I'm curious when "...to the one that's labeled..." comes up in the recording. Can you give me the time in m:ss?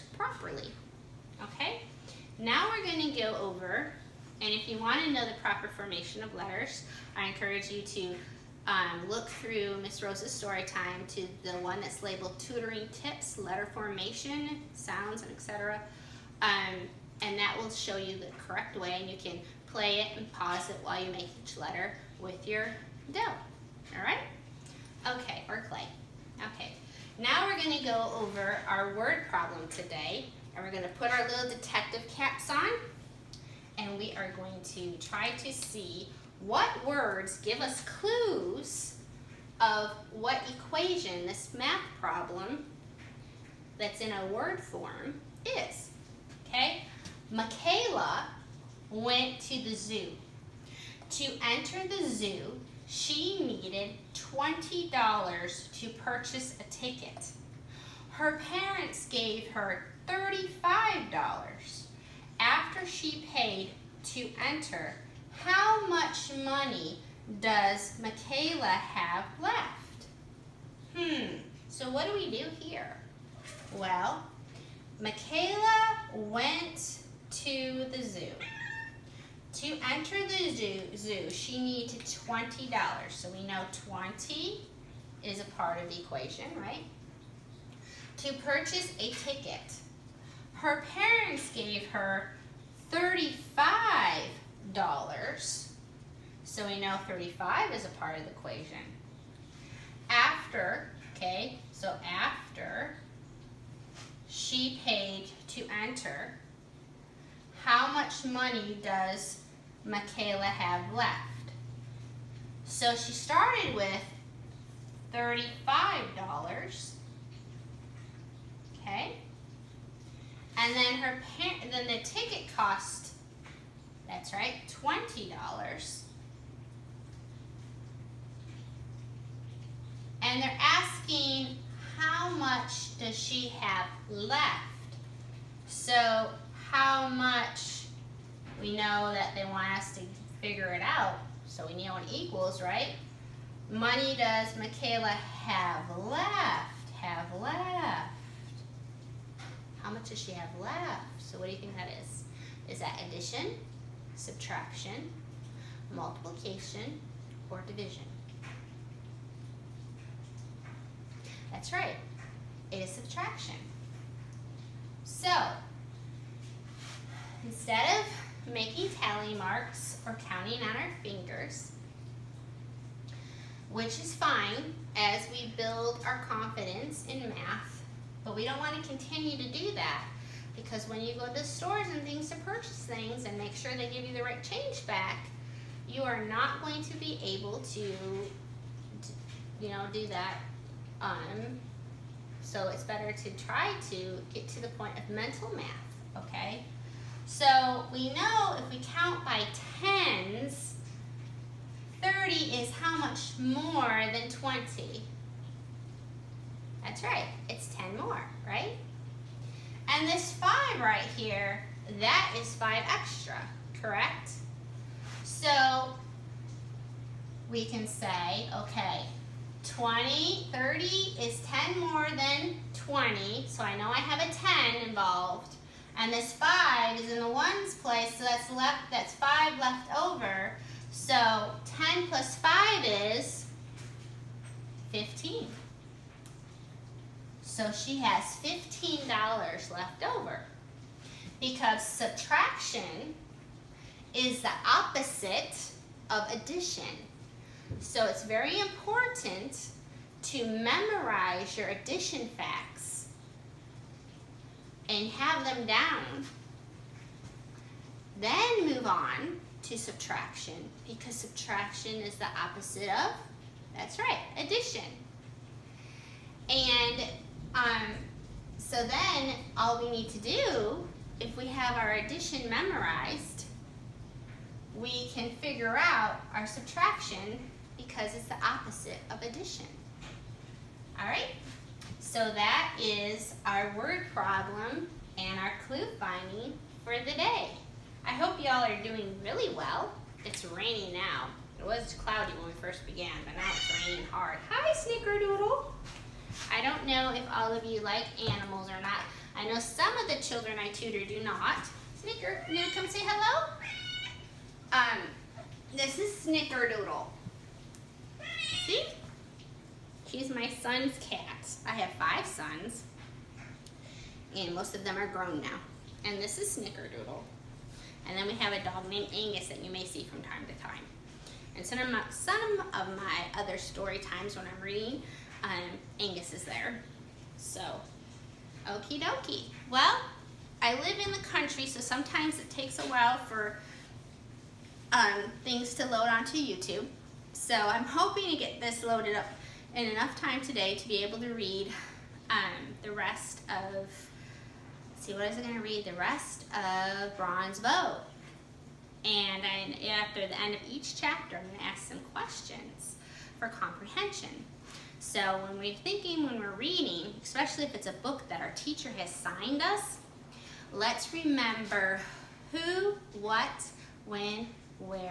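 0:11.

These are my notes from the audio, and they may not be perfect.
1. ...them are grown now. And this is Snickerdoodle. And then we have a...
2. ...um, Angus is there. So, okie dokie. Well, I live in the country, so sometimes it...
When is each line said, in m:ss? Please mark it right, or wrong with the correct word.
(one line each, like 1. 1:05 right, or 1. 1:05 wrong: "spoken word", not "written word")
1. 5:14 right
2. 5:25 right.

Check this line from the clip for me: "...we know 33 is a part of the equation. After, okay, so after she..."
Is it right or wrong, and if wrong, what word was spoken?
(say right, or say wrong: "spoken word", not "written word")
wrong: "35", not "33".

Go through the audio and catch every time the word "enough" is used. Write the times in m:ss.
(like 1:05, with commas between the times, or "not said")
5:39.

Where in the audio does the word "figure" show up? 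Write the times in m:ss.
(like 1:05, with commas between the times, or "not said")
2:20, 4:35.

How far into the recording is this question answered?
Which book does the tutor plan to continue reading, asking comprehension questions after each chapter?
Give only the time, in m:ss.
5:47.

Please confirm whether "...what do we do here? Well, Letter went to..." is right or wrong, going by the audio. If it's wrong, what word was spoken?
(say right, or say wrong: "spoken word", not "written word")
wrong: "Michaela", not "Letter".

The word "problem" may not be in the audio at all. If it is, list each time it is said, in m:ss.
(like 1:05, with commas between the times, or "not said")
0:29, 0:42, 4:44.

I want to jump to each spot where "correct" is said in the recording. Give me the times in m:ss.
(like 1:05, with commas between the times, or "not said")
0:18, 3:33.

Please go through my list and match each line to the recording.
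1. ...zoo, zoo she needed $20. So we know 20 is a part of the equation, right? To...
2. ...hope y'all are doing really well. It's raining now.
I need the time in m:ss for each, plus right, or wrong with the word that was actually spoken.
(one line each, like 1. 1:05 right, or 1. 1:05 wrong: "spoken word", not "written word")
1. 1:20 right
2. 4:48 right.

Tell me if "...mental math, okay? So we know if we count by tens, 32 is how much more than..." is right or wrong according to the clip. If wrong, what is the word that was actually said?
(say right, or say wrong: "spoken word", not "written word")
wrong: "30", not "32".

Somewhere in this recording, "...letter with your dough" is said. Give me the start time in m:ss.
0:21.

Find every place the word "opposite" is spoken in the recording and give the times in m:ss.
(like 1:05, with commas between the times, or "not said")
4:04, 4:22, 4:38.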